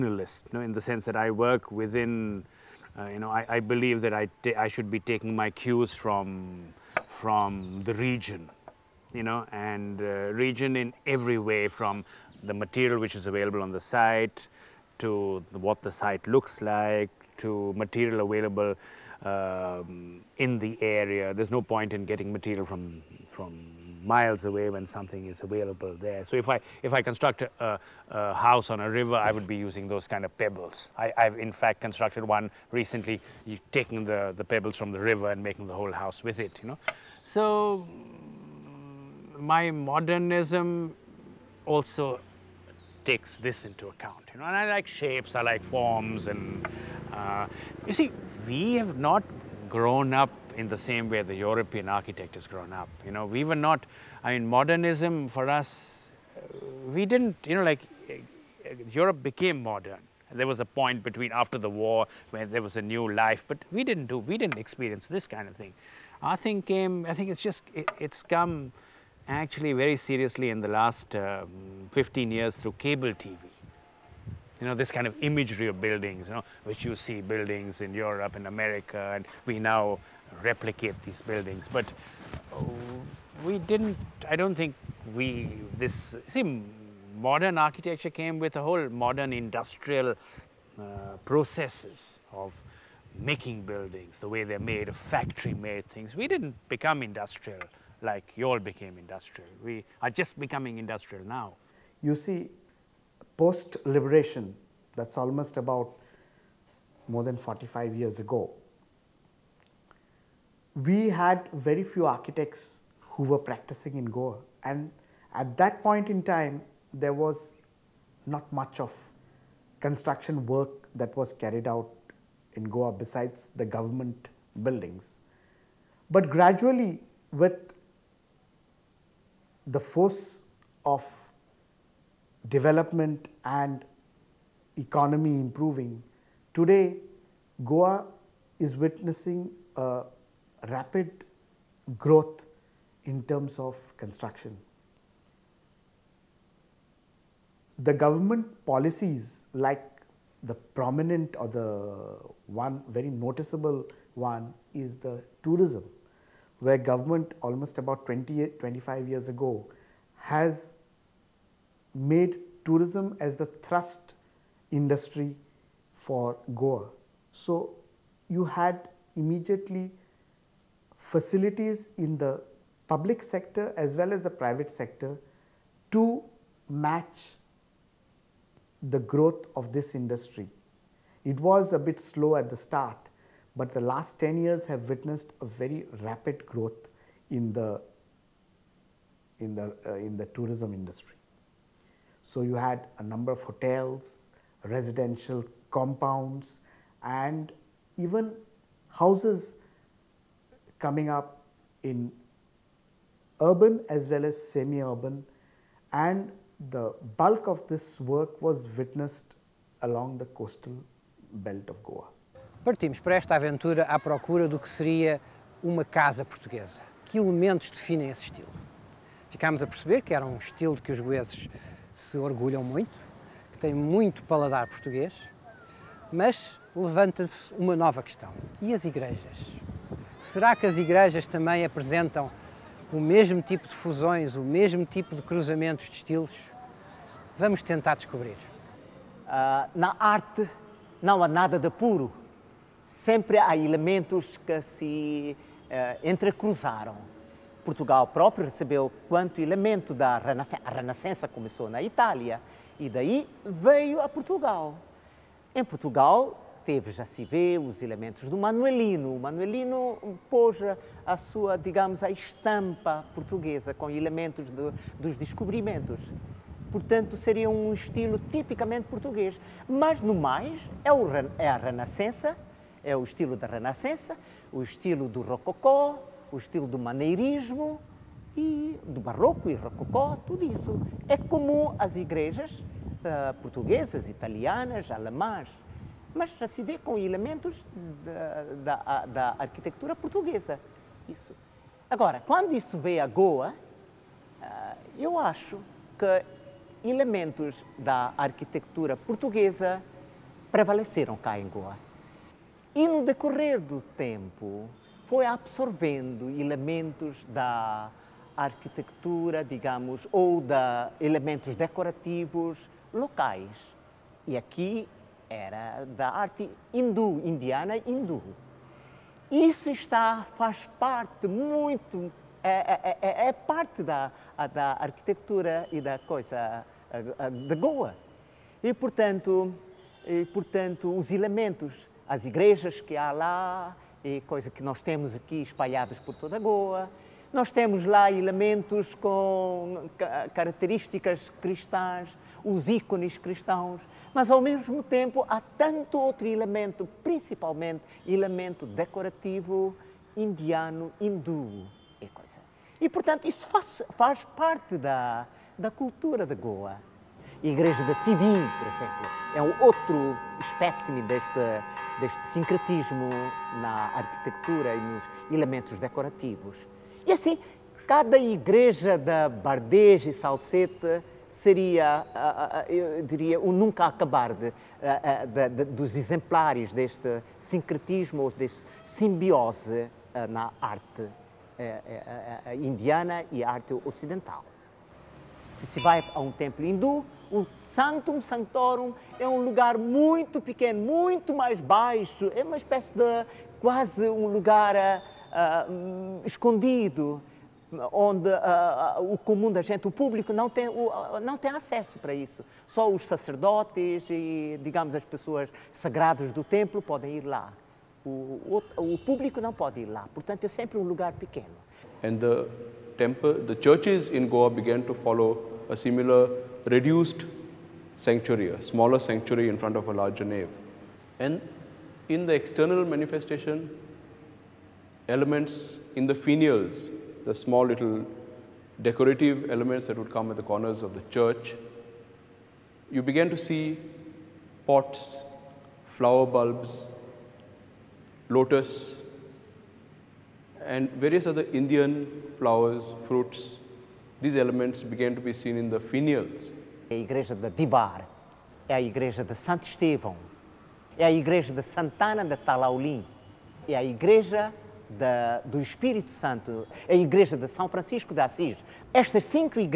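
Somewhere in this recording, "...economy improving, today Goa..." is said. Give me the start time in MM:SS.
02:14.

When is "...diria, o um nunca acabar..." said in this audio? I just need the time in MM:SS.
06:13.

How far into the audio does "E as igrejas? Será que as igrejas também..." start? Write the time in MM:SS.
03:48.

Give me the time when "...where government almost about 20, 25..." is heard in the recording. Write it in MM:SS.
02:36.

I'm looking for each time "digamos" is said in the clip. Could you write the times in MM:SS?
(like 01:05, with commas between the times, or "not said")
04:21, 05:09, 06:44.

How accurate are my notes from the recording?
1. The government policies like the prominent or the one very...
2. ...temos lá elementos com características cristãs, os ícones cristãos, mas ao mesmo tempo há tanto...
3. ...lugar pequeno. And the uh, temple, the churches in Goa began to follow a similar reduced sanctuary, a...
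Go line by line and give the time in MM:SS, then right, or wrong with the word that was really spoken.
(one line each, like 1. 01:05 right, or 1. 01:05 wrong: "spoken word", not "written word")
1. 02:27 right
2. 05:37 right
3. 06:50 right.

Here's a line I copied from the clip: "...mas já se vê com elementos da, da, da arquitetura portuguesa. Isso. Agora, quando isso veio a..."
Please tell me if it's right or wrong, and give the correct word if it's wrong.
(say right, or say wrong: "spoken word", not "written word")
right.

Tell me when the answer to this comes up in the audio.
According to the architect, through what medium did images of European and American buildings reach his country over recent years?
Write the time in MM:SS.
01:12.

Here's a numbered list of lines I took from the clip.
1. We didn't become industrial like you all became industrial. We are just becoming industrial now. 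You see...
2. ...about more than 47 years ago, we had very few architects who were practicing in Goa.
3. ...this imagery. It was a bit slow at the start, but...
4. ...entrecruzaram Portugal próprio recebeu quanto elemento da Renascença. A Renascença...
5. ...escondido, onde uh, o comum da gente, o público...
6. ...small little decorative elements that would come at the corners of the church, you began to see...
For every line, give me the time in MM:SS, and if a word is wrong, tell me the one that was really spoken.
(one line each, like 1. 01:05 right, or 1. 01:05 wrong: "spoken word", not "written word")
1. 01:36 right
2. 01:45 wrong: "45", not "47"
3. 02:59 wrong: "industry", not "imagery"
4. 04:06 right
5. 06:36 right
6. 07:07 right.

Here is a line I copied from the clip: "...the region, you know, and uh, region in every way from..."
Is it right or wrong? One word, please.
right.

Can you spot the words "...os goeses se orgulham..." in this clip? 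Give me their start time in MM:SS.
03:40.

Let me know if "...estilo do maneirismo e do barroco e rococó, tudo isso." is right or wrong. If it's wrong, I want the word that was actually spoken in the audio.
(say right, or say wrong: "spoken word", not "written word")
right.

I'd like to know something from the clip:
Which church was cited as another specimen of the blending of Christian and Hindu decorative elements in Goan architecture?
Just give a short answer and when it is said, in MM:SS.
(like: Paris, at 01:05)
igreja da Tivim, at 05:57.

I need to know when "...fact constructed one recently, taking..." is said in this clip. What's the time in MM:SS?
00:31.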